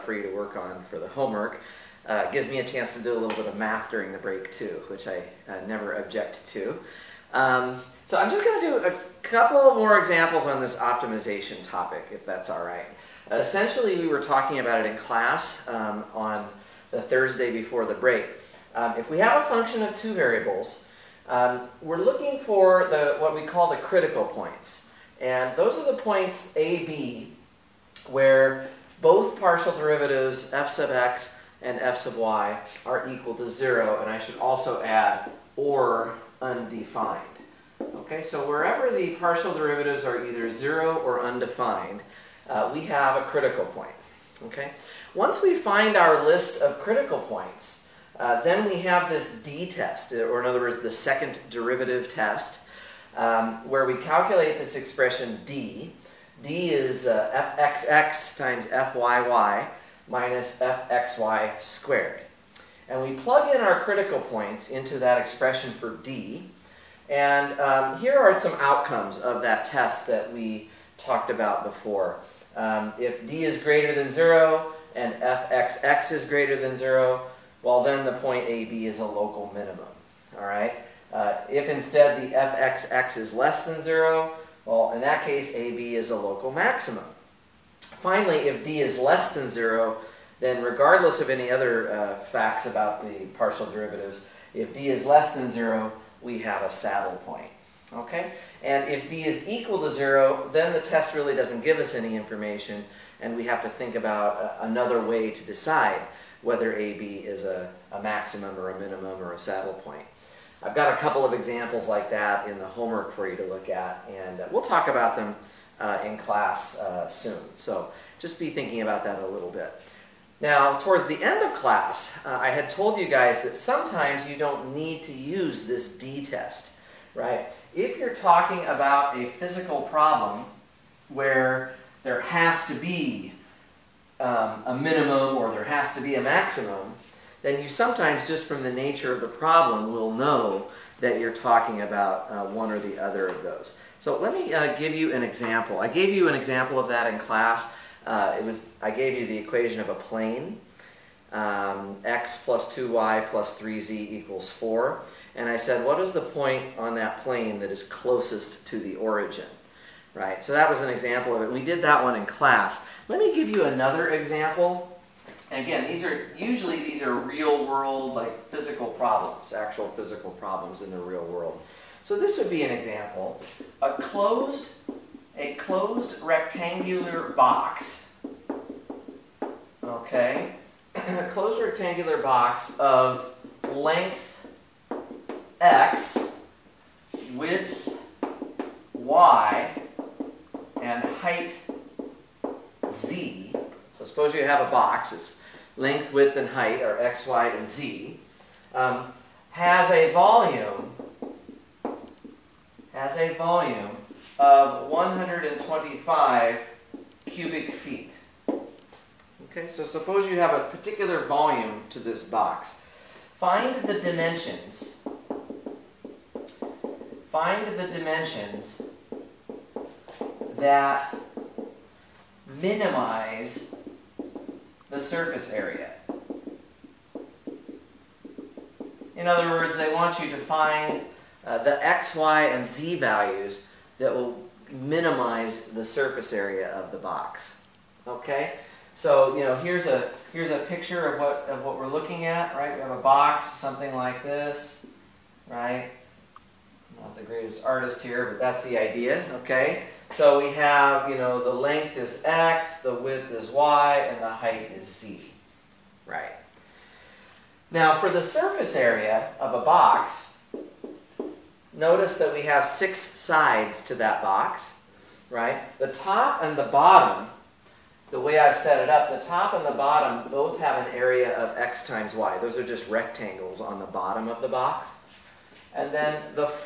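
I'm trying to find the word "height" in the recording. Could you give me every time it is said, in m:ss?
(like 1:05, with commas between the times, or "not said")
3:11, 3:16, 4:14.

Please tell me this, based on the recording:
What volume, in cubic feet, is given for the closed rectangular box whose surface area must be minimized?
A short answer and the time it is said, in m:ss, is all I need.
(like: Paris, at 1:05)
125 cubic feet, at 3:24.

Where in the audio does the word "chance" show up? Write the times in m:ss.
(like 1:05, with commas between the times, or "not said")
0:02.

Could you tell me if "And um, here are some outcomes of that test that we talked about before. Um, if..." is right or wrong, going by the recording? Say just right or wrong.
right.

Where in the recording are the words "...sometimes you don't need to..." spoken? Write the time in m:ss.
2:03.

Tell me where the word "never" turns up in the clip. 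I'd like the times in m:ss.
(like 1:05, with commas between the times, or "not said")
0:05.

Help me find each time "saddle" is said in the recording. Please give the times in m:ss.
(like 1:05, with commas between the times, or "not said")
1:36, 1:49.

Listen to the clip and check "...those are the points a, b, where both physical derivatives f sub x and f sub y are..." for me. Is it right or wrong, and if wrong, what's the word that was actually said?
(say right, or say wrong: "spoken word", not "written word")
wrong: "partial", not "physical".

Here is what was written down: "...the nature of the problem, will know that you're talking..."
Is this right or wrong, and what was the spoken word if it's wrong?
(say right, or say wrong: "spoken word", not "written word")
right.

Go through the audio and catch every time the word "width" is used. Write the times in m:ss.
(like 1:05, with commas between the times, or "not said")
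3:07, 3:16, 4:12.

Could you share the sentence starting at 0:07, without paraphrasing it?
Um, so I'm just going to do a couple more examples on this optimization topic, if that's all right.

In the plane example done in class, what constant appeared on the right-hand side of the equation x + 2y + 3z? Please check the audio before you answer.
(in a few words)
4.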